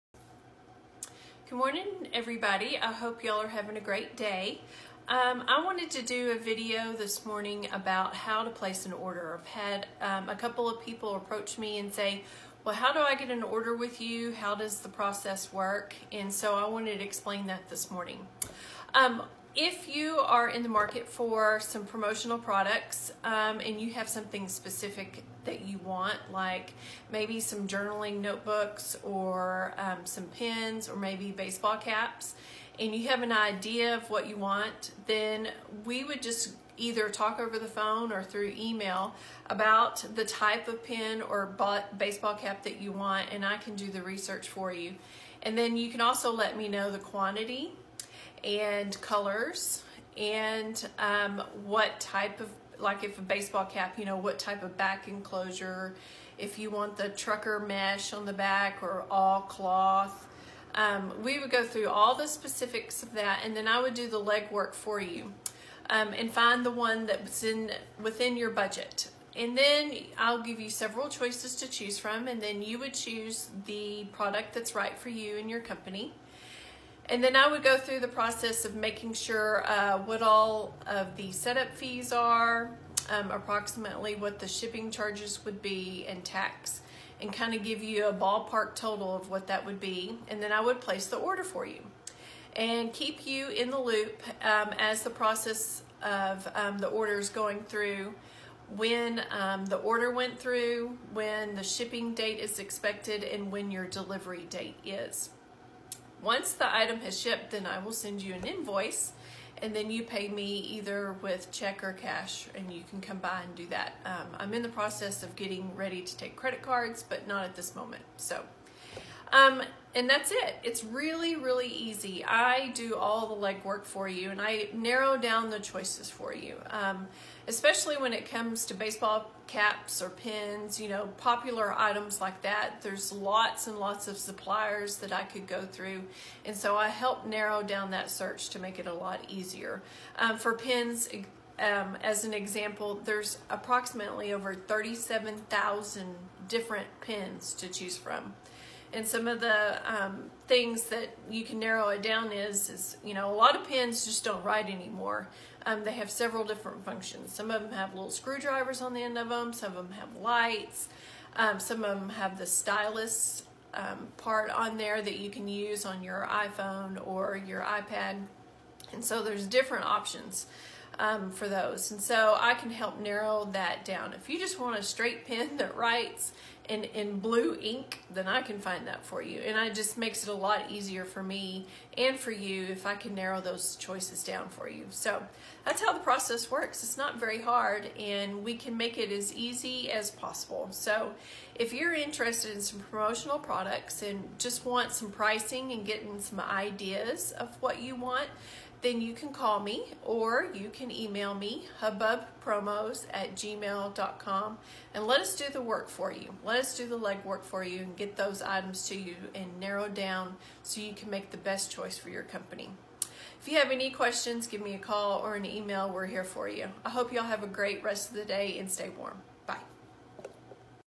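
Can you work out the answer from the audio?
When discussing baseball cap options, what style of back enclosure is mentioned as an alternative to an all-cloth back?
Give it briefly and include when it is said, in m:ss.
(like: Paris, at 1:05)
trucker mesh, at 0:57.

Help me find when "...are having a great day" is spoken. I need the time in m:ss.
0:03.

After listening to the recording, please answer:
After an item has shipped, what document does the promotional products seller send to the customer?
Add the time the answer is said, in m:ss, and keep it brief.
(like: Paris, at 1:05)
an invoice, at 1:48.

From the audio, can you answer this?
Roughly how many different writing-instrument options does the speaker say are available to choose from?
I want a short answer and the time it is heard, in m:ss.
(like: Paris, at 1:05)
37,000, at 2:24.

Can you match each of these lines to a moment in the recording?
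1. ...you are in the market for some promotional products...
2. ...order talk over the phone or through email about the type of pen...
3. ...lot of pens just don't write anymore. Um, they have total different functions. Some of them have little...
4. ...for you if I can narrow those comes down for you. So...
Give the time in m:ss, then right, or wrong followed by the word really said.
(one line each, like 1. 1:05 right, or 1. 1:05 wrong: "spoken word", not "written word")
1. 0:19 right
2. 0:36 wrong: "either", not "order"
3. 2:33 wrong: "several", not "total"
4. 3:02 wrong: "choices", not "comes".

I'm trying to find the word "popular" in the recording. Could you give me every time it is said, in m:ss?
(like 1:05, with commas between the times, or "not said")
2:11.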